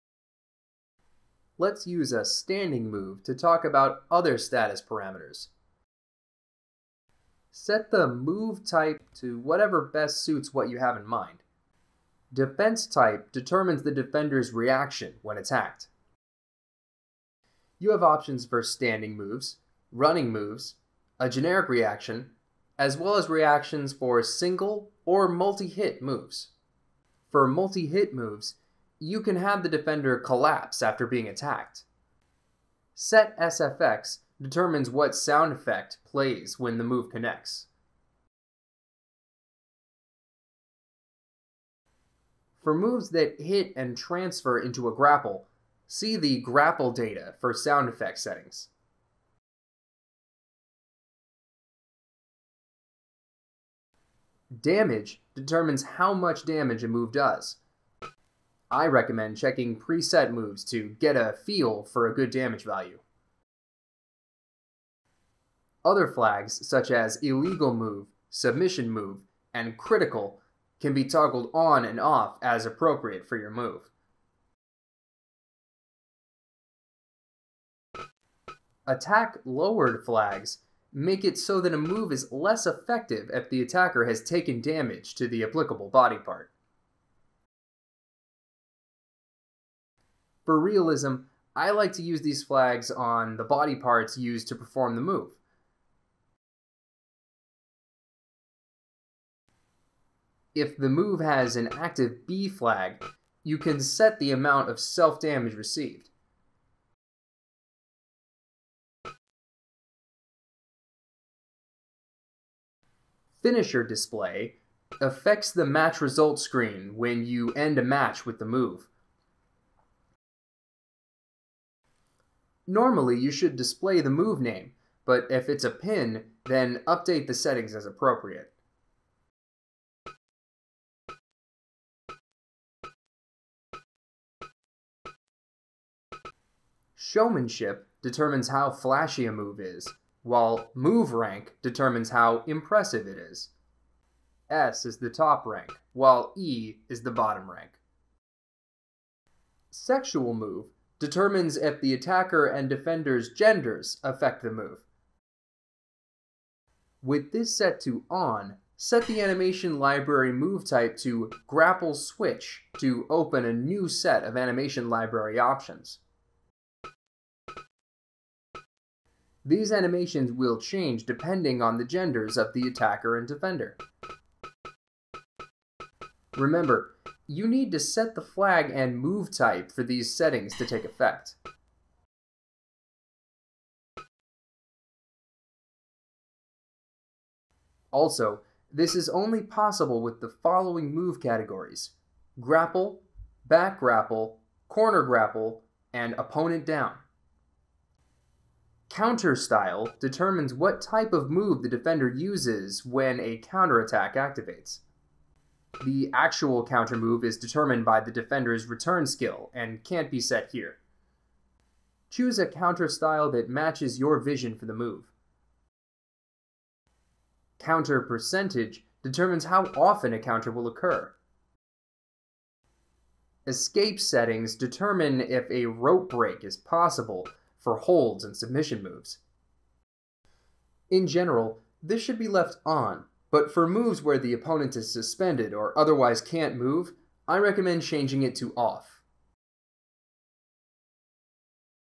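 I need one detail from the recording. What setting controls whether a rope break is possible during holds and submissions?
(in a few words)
Escape settings.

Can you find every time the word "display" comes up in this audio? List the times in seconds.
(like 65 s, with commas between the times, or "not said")
113 s, 123 s.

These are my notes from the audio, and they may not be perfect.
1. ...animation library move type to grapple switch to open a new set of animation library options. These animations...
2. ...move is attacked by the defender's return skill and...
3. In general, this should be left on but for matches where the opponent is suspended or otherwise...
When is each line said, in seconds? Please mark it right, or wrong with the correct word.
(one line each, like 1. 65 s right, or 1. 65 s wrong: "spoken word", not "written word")
1. 159 s right
2. 206 s wrong: "determined", not "attacked"
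3. 230 s wrong: "moves", not "matches".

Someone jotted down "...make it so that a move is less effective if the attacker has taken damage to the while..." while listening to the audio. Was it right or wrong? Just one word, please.
wrong.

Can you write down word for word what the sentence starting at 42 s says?
For moves that hit and transfer into a grapple, see the grapple data for sound effect settings.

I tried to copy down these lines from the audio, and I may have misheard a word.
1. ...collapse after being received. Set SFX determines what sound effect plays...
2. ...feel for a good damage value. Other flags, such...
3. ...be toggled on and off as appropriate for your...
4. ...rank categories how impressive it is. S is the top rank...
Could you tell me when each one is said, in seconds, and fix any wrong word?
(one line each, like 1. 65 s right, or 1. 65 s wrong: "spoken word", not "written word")
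1. 30 s wrong: "attacked", not "received"
2. 61 s right
3. 70 s right
4. 141 s wrong: "determines", not "categories".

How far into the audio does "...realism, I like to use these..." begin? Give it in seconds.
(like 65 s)
90 s.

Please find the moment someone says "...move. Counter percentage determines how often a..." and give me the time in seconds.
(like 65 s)
214 s.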